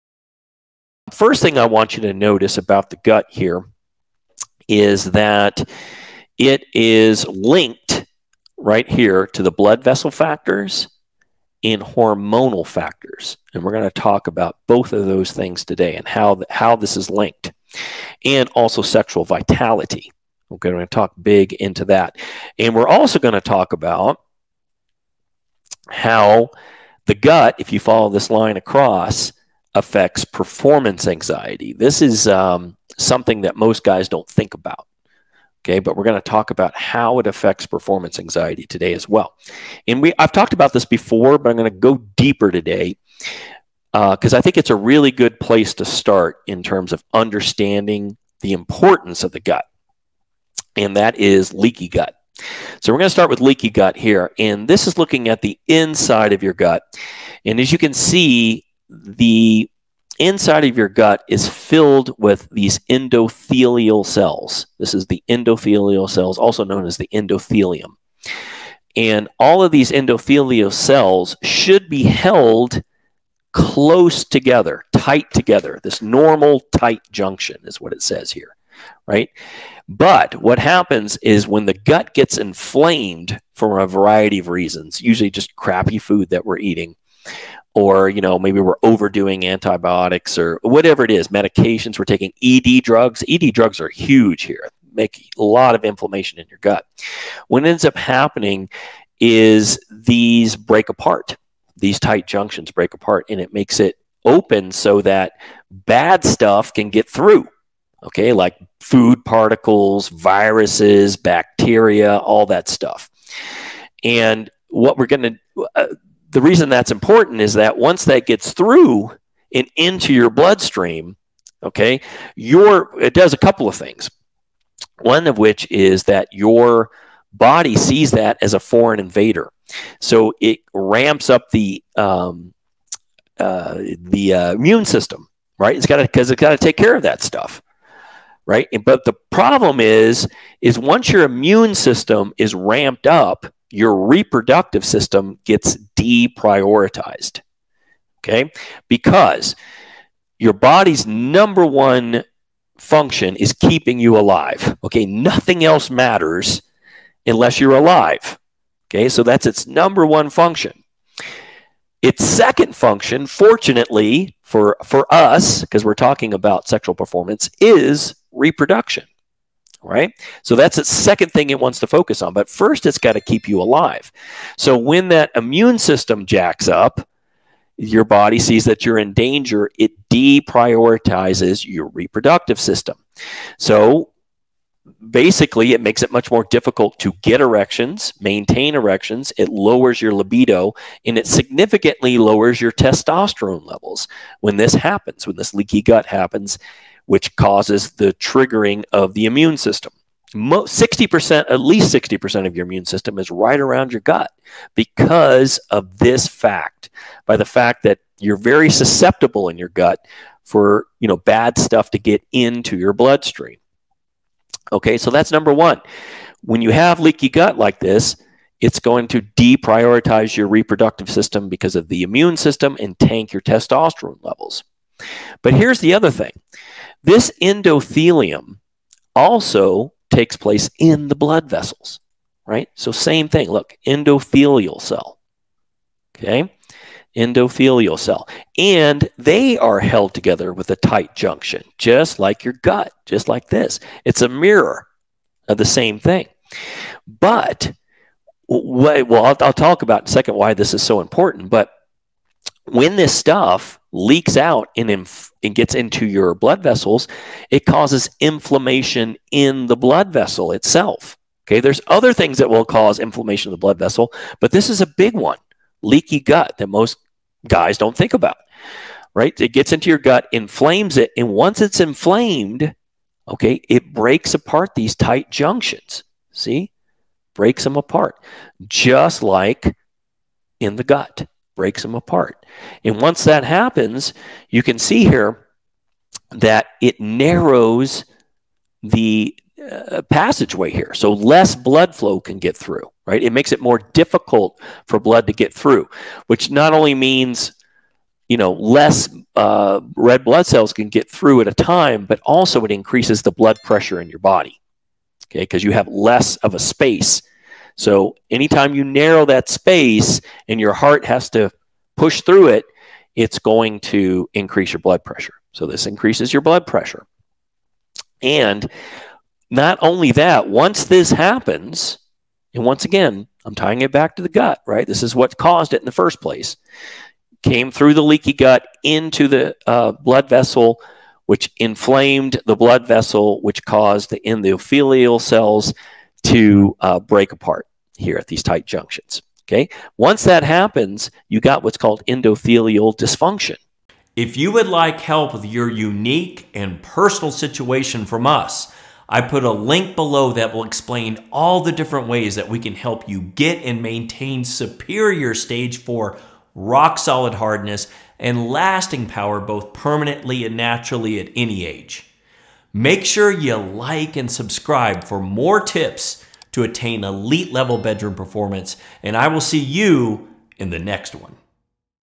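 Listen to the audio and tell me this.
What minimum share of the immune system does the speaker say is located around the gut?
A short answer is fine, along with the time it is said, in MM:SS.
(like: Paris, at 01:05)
60%, at 03:21.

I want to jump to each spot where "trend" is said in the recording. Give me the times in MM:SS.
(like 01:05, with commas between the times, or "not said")
not said.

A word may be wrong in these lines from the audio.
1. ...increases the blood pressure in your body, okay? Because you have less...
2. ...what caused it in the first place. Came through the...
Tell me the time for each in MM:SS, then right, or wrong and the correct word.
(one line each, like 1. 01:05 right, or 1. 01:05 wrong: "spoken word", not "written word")
1. 05:02 right
2. 05:25 right.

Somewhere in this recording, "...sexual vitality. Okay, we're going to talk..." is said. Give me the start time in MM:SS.
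00:18.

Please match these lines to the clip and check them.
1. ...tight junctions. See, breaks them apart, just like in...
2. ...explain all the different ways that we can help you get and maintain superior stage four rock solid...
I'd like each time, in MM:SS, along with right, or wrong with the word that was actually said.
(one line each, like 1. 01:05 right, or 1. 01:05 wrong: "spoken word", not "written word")
1. 04:34 right
2. 05:50 right.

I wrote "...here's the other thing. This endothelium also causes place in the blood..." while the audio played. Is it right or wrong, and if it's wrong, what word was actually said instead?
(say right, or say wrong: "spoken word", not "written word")
wrong: "takes", not "causes".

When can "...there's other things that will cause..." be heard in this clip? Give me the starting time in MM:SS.
04:21.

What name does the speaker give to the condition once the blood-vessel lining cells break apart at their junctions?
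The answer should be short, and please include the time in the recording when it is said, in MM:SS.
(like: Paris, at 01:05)
endothelial dysfunction, at 05:42.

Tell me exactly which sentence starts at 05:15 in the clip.
So this increases your blood pressure.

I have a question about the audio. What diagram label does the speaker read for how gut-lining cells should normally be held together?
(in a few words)
normal tight junction.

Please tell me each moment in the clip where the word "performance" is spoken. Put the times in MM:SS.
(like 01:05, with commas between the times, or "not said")
00:30, 00:37, 02:46, 06:08.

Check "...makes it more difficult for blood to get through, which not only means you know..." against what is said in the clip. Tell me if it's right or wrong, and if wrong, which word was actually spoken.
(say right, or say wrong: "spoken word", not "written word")
right.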